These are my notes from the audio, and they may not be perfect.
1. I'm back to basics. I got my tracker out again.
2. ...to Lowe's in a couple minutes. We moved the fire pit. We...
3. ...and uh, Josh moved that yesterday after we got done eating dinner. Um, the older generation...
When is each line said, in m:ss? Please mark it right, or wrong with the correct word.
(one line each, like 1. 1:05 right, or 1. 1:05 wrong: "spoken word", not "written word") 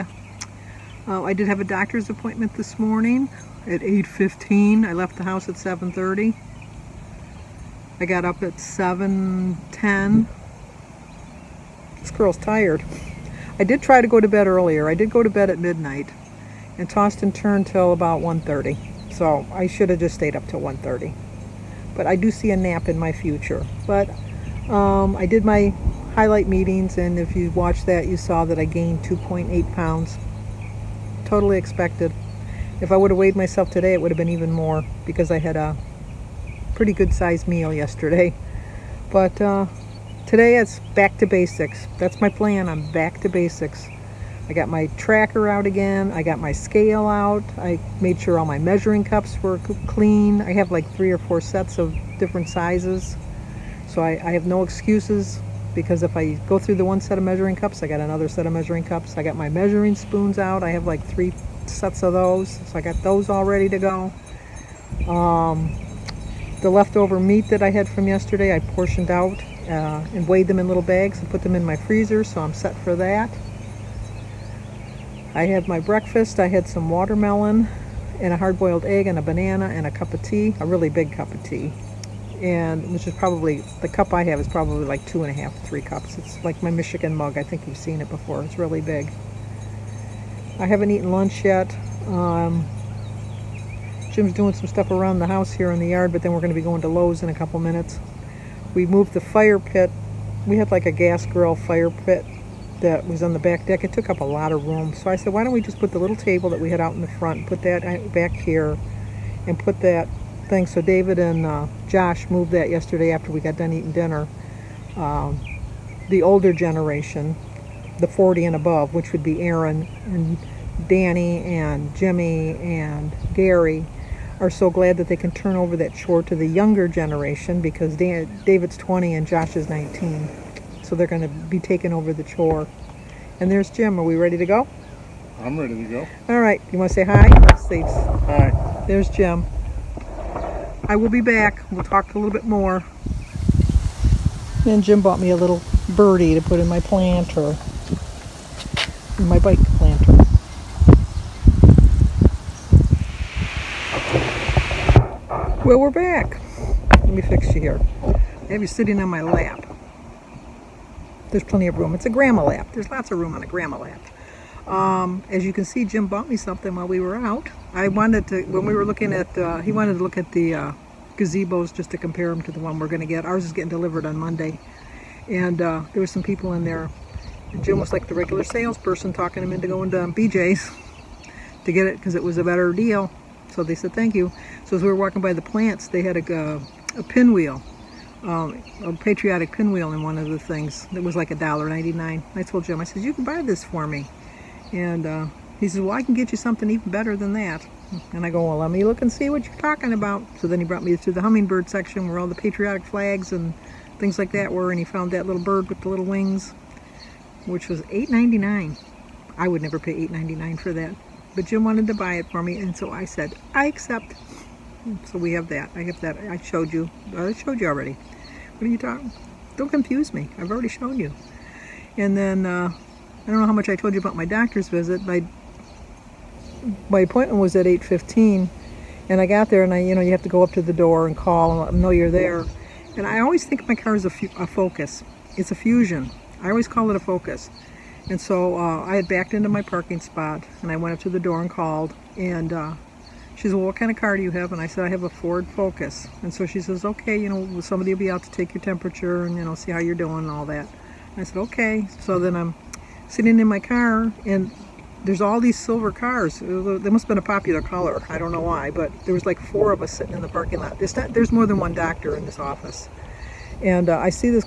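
1. 0:42 right
2. 1:36 right
3. 1:51 right.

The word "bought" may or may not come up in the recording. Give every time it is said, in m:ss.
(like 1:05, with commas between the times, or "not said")
2:25, 2:46.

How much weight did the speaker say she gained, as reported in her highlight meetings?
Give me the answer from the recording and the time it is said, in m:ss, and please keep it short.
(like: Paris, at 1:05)
2.8 pounds, at 0:29.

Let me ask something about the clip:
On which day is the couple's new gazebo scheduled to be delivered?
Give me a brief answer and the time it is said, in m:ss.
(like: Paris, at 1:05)
Monday, at 2:54.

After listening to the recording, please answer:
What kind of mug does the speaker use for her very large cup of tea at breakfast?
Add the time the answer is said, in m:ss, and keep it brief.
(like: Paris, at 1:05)
Michigan mug, at 1:26.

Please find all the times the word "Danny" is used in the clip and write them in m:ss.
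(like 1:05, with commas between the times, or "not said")
2:00.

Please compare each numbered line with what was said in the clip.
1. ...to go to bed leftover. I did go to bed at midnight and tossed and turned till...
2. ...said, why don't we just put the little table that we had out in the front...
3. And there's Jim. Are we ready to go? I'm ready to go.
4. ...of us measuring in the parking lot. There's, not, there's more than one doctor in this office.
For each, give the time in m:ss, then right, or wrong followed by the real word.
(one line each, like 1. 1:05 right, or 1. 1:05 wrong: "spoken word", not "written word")
1. 0:14 wrong: "earlier", not "leftover"
2. 1:45 right
3. 2:13 right
4. 4:19 wrong: "sitting", not "measuring".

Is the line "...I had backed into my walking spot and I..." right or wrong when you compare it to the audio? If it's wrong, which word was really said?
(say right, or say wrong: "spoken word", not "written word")
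wrong: "parking", not "walking".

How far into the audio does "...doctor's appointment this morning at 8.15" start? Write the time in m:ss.
0:01.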